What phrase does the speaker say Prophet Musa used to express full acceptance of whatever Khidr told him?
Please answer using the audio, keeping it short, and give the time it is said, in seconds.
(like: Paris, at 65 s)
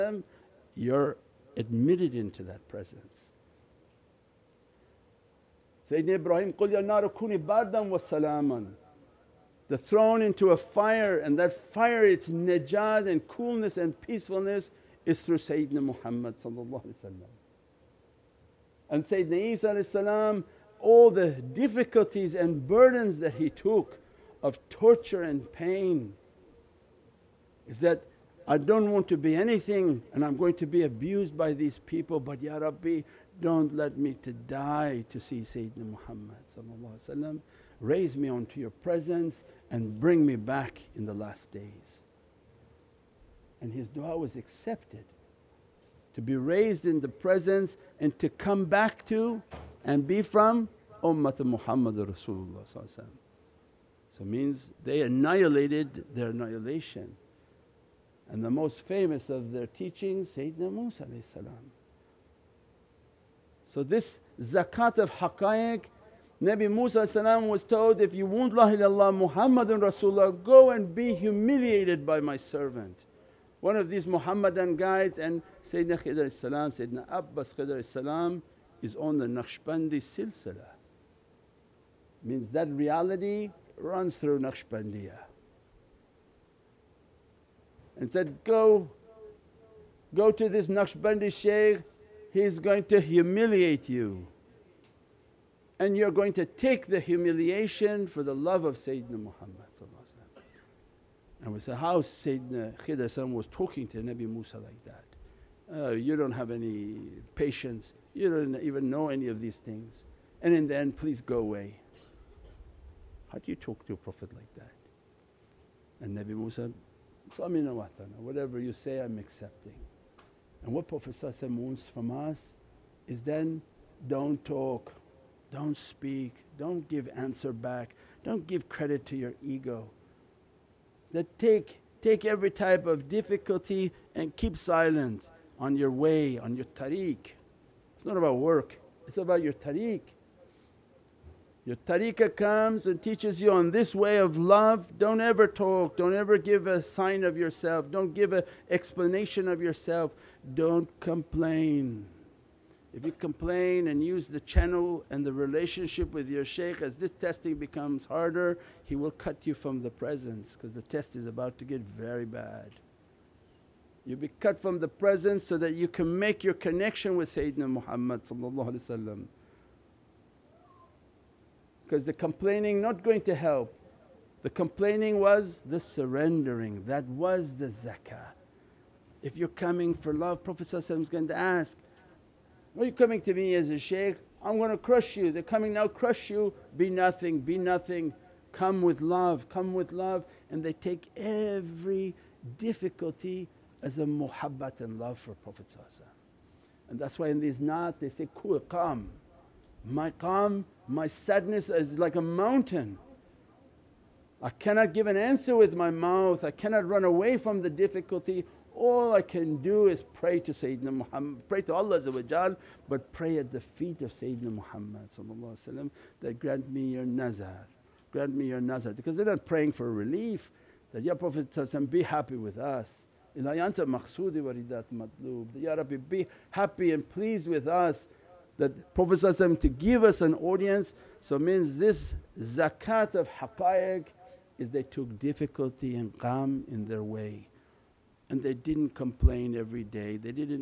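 Samina watana, at 117 s.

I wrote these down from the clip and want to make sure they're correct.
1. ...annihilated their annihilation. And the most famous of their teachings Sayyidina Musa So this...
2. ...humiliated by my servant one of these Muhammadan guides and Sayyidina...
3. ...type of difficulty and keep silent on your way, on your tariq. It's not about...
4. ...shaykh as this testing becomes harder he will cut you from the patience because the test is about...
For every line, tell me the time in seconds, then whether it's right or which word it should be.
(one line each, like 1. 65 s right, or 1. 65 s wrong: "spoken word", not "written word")
1. 55 s right
2. 71 s right
3. 132 s right
4. 156 s wrong: "presence", not "patience".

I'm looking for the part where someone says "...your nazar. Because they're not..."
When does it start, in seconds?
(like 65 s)
218 s.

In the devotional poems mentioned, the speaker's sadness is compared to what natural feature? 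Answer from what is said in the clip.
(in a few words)
a mountain.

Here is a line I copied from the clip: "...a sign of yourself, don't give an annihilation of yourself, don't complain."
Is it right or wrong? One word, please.
wrong.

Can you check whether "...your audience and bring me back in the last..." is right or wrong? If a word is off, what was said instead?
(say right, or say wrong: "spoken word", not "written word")
wrong: "presence", not "audience".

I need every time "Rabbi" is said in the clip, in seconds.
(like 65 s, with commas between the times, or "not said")
32 s, 225 s.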